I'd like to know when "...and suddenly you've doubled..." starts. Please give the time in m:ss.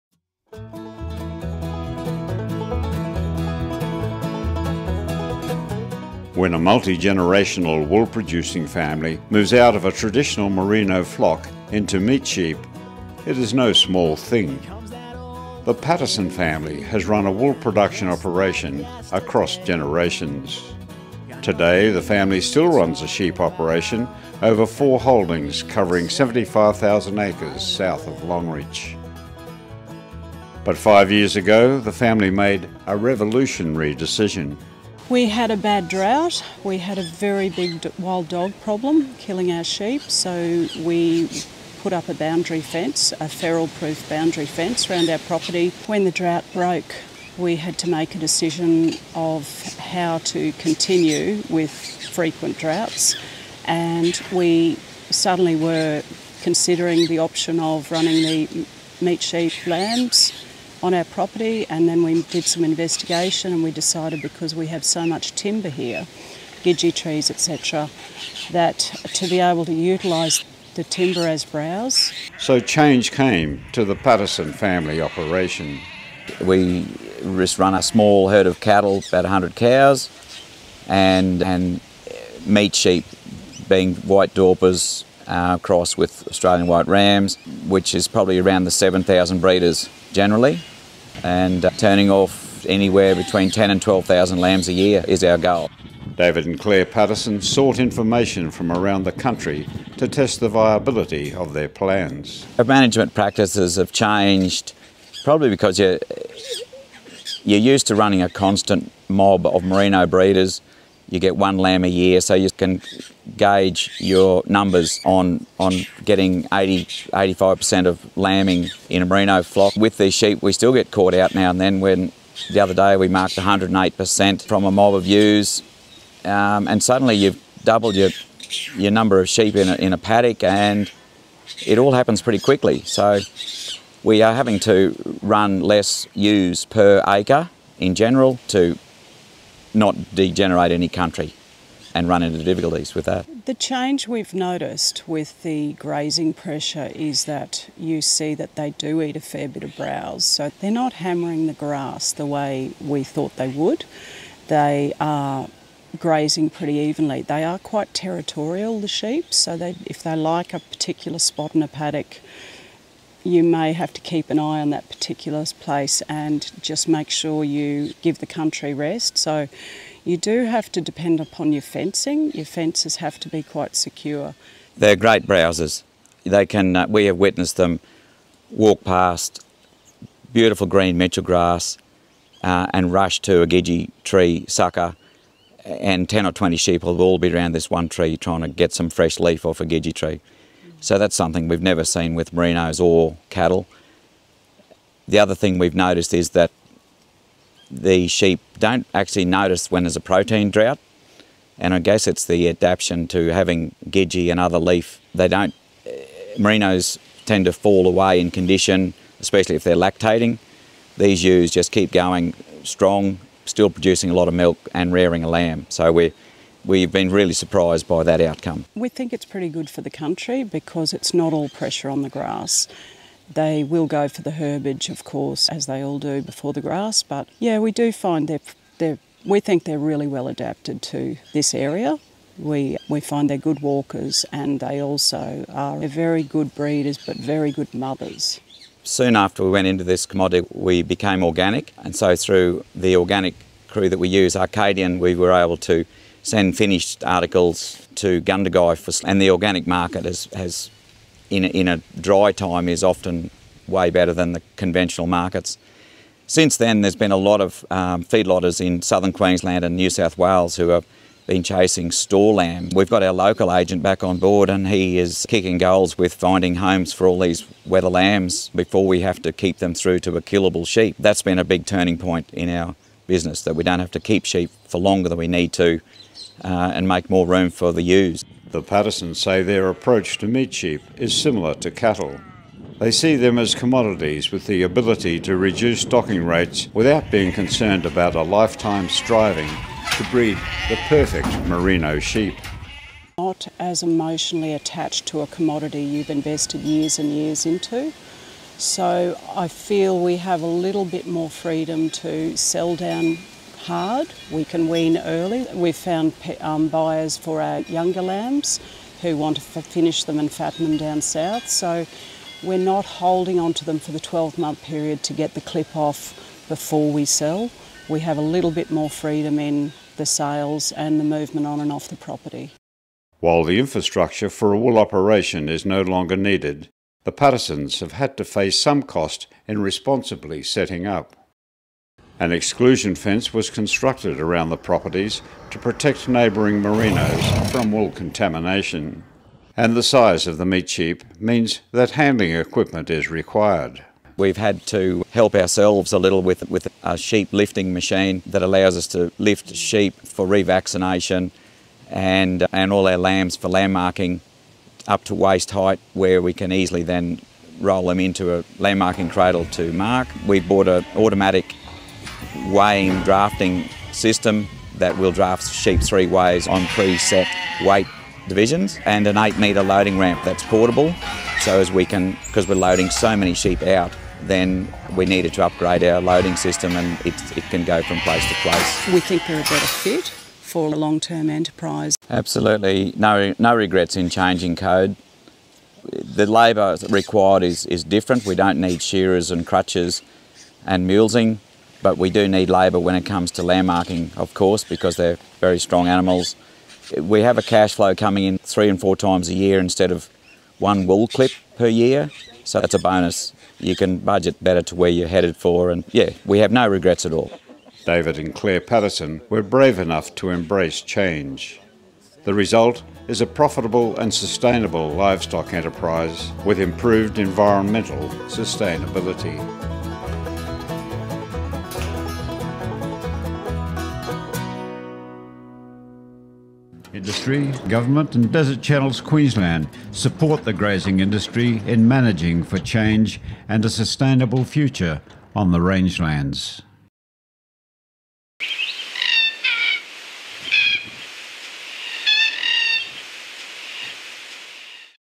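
2:06.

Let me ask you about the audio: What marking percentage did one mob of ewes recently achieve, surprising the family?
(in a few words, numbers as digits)
108%.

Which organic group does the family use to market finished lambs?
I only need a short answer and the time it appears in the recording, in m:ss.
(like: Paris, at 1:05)
Arcadian, at 4:04.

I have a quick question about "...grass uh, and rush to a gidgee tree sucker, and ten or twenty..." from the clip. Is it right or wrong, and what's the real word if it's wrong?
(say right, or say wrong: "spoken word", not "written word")
right.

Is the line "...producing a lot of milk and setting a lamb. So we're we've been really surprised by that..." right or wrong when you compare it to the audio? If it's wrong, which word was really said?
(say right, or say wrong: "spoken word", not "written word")
wrong: "rearing", not "setting".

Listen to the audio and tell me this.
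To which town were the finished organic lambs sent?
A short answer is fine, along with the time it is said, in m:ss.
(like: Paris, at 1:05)
Gundagai, at 4:08.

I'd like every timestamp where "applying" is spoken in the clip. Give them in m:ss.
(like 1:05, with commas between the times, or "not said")
not said.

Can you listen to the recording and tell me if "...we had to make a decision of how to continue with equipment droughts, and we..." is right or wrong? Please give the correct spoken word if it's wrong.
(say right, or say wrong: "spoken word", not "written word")
wrong: "frequent", not "equipment".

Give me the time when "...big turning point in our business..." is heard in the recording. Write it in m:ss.
4:31.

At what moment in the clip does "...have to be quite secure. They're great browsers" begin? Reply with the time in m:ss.
2:52.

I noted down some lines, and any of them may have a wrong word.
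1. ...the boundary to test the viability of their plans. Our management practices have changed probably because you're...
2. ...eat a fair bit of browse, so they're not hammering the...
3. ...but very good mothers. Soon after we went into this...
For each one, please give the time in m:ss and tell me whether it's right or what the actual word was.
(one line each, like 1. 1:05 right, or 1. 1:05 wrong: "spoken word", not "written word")
1. 1:39 wrong: "country", not "boundary"
2. 2:29 right
3. 3:56 right.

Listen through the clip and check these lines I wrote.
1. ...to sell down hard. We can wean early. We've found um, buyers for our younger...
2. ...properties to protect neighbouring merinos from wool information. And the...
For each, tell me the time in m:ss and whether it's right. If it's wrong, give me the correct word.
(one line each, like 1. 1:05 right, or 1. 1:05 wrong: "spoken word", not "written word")
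1. 5:01 right
2. 5:34 wrong: "contamination", not "information".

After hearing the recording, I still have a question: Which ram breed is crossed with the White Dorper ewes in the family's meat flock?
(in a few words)
Australian White.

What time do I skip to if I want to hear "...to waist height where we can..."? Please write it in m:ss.
5:55.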